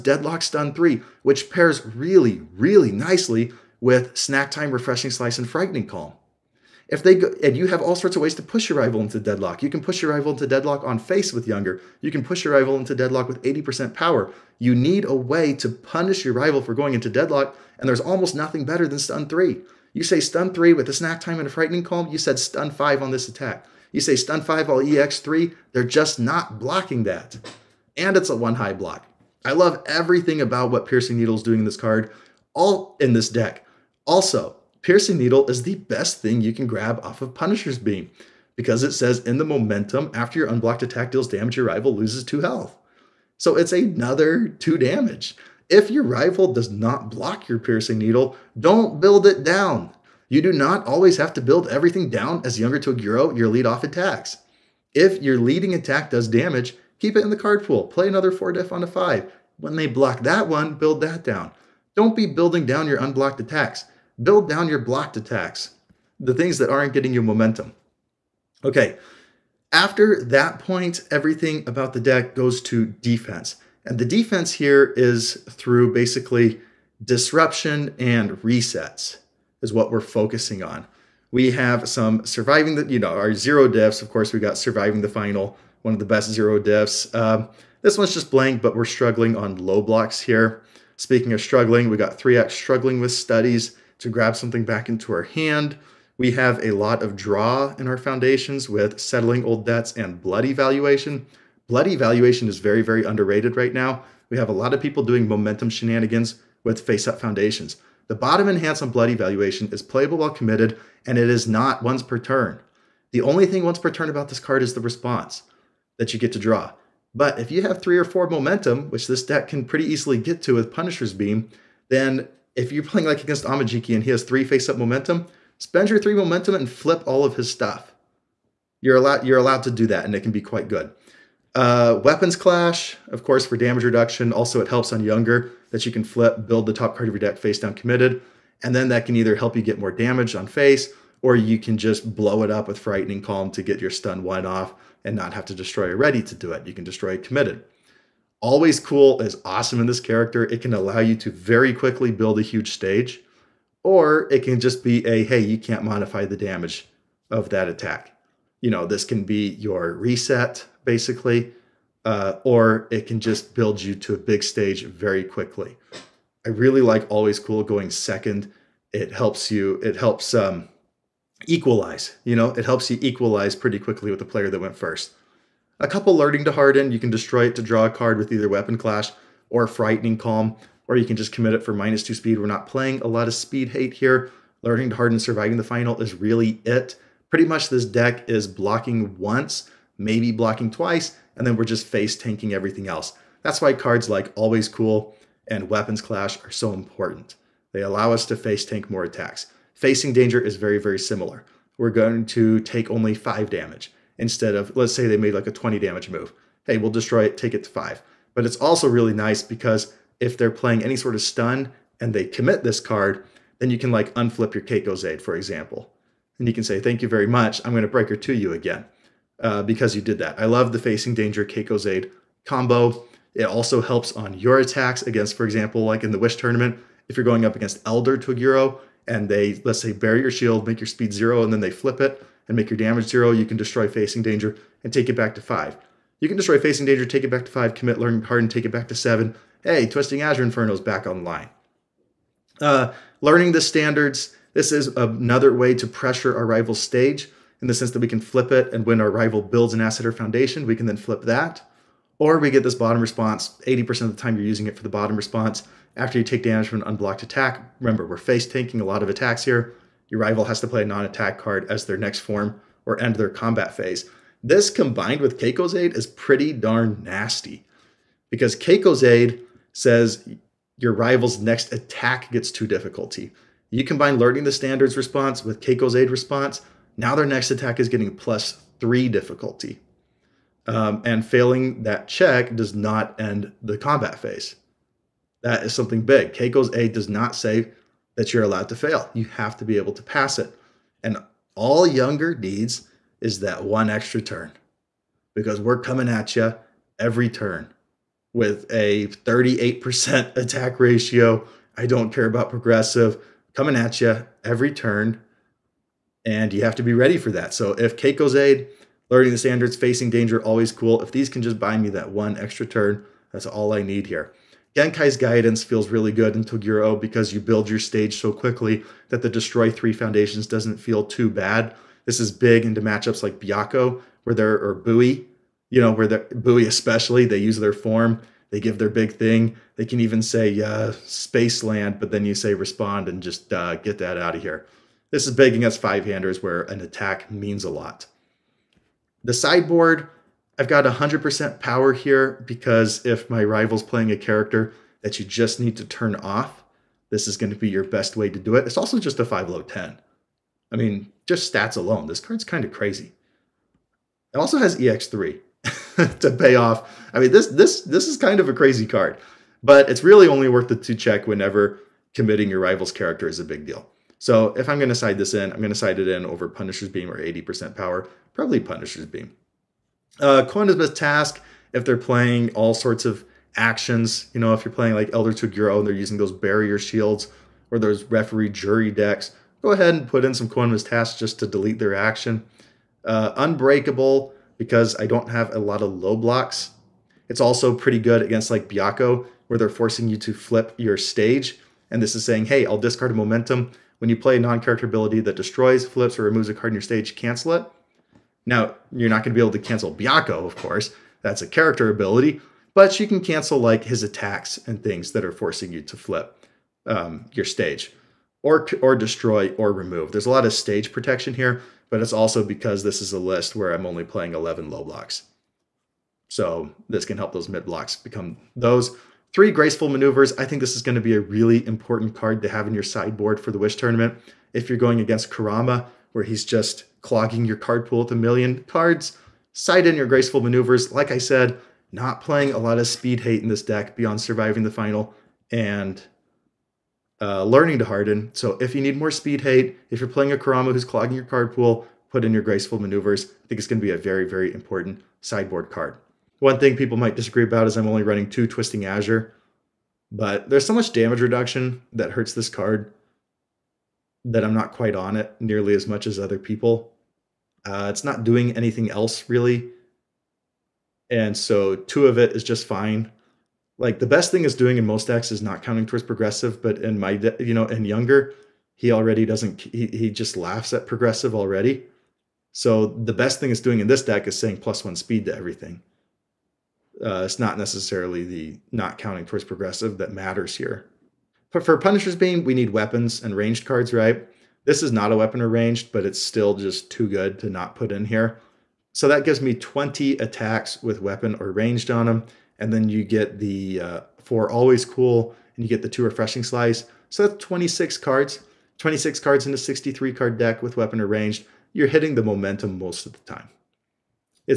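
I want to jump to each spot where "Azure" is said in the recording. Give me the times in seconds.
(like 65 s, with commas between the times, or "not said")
240 s, 448 s.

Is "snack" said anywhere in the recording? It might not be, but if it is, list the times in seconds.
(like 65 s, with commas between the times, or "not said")
4 s, 20 s.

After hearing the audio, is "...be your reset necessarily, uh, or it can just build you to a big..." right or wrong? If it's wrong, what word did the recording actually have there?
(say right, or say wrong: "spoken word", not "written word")
wrong: "basically", not "necessarily".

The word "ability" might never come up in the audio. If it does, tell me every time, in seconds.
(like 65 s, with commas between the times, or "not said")
394 s, 401 s.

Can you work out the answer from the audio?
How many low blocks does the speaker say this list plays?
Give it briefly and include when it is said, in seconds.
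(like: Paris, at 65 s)
11, at 414 s.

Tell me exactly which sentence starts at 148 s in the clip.
Always cool is awesome in this character.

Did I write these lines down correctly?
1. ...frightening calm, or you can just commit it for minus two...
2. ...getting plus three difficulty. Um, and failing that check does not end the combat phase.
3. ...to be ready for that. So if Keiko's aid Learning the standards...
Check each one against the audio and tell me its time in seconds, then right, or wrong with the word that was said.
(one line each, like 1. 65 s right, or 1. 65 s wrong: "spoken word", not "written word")
1. 179 s right
2. 277 s right
3. 306 s right.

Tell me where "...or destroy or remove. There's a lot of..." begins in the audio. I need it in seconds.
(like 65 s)
408 s.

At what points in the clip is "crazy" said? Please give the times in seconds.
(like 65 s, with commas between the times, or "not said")
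352 s, 358 s.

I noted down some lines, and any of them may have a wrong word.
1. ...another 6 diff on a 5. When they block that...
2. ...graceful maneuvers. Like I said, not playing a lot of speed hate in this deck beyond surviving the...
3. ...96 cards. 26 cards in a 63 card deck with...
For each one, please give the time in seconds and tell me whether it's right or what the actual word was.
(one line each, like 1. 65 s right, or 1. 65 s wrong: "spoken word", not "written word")
1. 58 s wrong: "4", not "6"
2. 430 s right
3. 497 s wrong: "26", not "96".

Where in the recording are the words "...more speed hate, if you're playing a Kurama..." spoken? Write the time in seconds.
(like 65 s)
438 s.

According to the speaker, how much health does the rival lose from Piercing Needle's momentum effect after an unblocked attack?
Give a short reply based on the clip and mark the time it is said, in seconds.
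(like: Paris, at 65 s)
2, at 42 s.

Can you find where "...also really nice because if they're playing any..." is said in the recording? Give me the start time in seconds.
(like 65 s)
208 s.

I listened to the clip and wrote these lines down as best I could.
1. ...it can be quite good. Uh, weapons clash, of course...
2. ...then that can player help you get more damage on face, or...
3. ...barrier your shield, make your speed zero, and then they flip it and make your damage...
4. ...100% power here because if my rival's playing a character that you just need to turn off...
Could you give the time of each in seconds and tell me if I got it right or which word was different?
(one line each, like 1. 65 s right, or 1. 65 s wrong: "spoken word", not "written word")
1. 130 s right
2. 138 s wrong: "either", not "player"
3. 229 s right
4. 340 s right.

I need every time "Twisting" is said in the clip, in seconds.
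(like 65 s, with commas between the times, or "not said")
239 s, 448 s.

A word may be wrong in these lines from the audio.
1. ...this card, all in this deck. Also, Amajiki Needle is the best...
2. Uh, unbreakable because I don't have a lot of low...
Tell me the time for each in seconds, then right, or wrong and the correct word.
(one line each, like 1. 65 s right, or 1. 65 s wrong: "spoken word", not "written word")
1. 31 s wrong: "Piercing", not "Amajiki"
2. 383 s right.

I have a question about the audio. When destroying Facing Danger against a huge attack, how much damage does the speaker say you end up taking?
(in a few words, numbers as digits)
5.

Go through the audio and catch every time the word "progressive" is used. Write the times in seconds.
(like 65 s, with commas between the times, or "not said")
302 s, 466 s, 470 s, 479 s.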